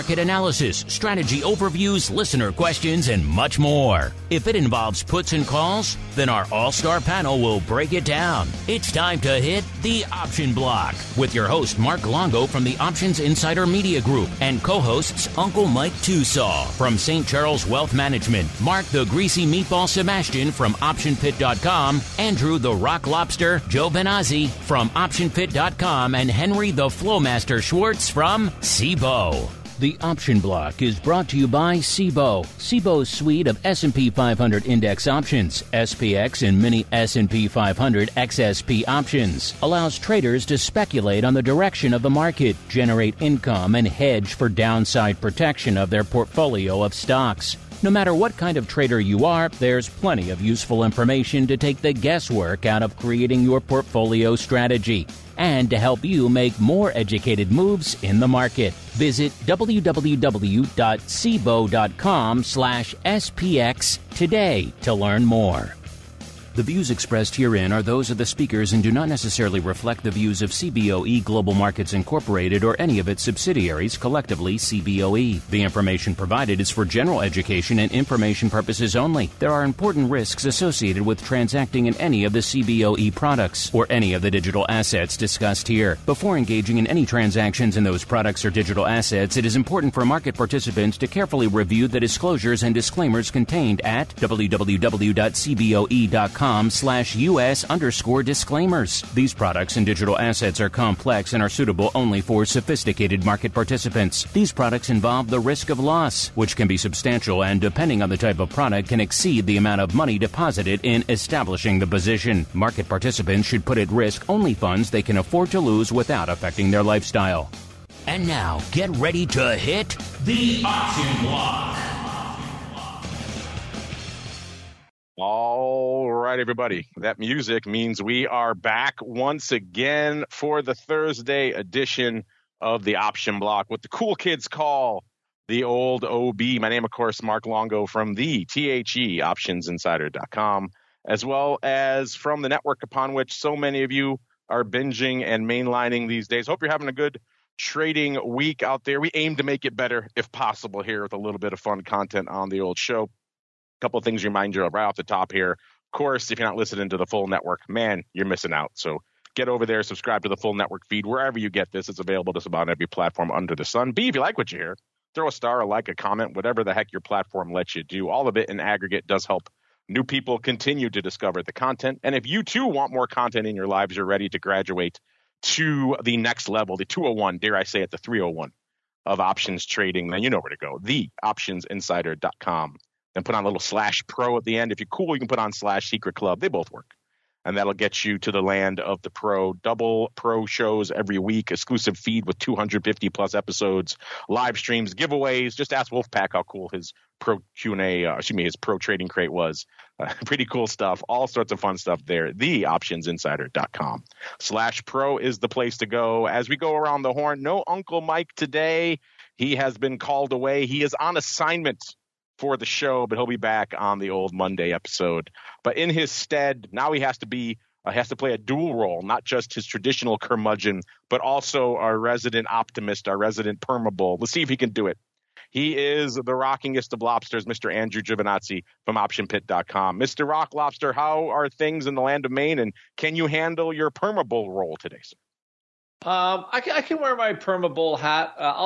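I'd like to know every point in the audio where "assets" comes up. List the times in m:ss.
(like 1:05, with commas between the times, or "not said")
1:24, 1:28, 1:40.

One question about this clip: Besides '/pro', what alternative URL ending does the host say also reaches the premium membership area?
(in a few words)
secret club.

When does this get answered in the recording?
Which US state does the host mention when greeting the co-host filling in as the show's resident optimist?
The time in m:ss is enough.
3:52.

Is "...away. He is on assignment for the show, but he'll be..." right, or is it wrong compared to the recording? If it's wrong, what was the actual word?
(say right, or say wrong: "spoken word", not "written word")
right.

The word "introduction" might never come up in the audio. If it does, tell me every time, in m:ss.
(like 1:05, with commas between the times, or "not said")
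not said.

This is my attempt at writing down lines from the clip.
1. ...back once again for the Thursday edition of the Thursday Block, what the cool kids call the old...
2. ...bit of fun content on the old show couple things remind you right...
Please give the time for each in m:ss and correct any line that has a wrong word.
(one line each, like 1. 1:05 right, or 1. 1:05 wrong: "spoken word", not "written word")
1. 2:08 wrong: "Option", not "Thursday"
2. 2:31 right.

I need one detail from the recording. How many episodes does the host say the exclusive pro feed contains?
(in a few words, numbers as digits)
250 plus.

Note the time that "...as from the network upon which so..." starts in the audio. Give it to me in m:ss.
2:21.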